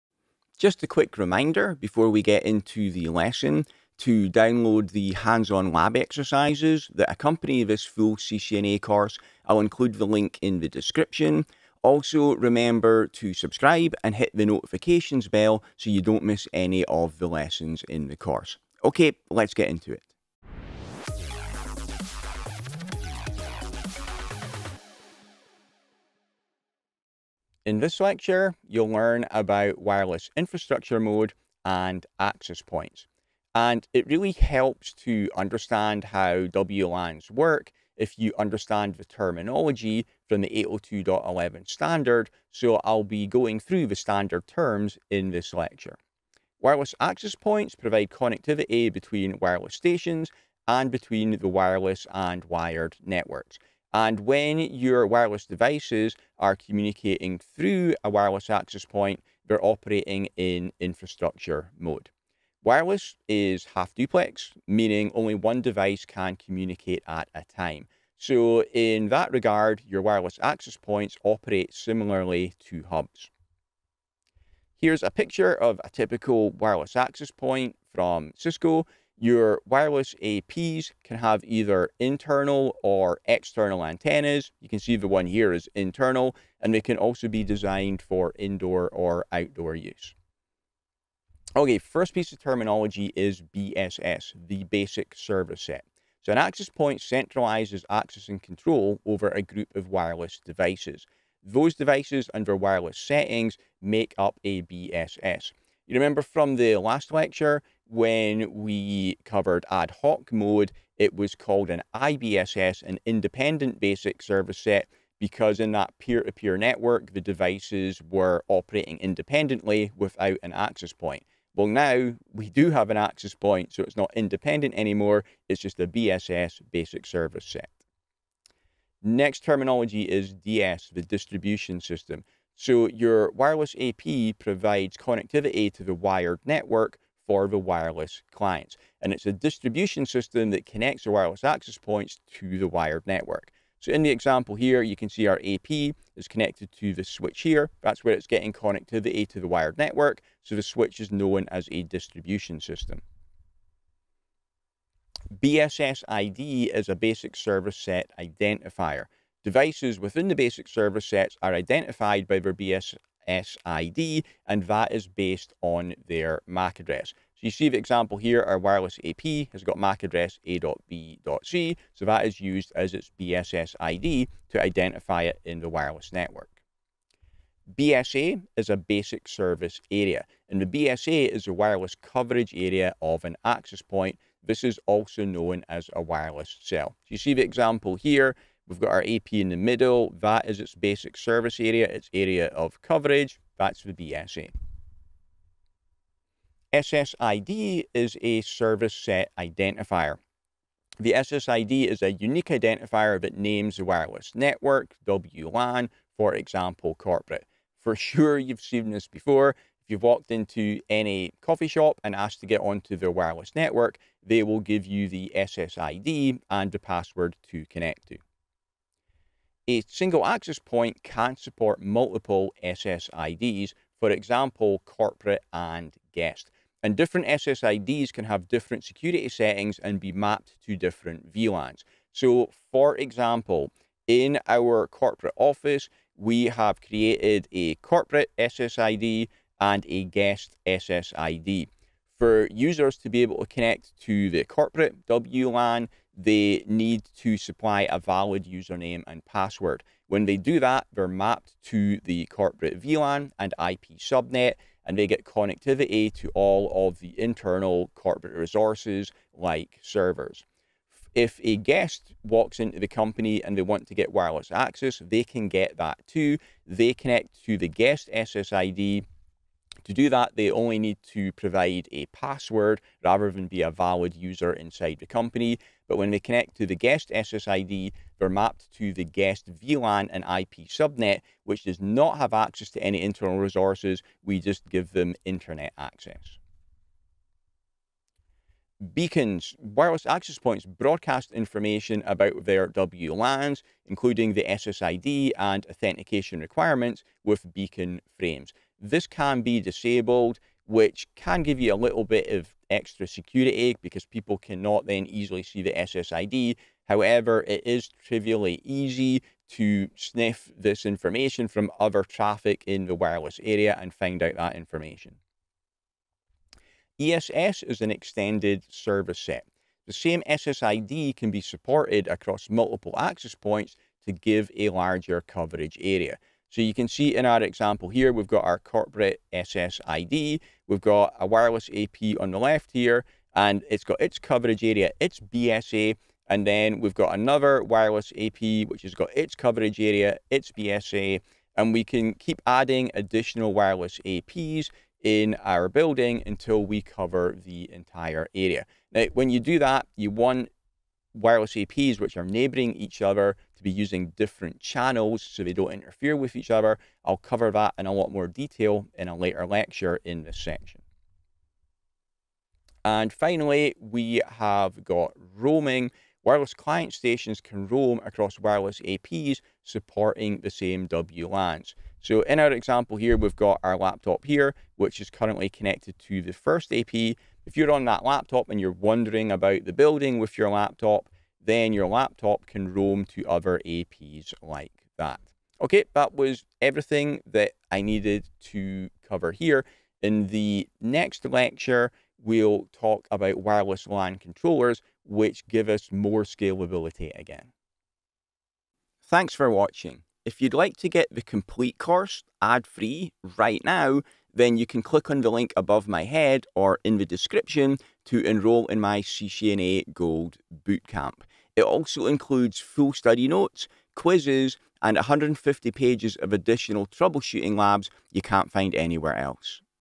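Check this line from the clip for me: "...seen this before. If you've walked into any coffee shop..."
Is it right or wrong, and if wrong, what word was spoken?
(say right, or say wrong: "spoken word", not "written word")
right.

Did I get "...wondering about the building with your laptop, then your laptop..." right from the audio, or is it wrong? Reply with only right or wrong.
right.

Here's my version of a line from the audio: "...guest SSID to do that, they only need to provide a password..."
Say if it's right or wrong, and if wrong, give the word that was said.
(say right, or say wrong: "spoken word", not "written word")
right.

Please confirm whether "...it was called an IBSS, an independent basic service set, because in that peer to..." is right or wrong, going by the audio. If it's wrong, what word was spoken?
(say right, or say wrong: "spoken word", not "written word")
right.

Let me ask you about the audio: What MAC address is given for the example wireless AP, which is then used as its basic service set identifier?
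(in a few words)
a.b.c.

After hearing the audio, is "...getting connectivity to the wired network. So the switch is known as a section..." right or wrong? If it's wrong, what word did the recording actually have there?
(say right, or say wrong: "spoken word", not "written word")
wrong: "distribution", not "section".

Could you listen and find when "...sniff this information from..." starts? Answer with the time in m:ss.
5:09.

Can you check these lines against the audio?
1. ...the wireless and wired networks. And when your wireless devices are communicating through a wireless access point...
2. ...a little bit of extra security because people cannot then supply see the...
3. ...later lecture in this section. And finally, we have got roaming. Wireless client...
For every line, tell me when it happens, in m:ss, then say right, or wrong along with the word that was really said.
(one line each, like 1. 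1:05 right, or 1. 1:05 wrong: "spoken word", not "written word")
1. 0:51 right
2. 5:01 wrong: "easily", not "supply"
3. 5:59 right.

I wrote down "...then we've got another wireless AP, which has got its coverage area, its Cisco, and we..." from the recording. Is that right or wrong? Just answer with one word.
wrong.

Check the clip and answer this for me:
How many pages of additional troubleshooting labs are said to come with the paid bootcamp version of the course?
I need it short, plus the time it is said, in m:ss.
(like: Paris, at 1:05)
150, at 6:54.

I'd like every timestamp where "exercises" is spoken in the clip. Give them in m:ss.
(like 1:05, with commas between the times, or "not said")
0:05.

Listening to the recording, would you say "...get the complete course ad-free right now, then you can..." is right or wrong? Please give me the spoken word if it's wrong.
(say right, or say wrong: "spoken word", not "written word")
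right.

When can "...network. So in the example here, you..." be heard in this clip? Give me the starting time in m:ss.
2:23.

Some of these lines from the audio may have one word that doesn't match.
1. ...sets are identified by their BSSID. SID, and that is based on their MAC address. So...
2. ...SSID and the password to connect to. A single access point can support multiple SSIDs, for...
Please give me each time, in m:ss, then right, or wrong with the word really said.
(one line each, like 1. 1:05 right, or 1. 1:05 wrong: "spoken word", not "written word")
1. 2:41 right
2. 3:35 right.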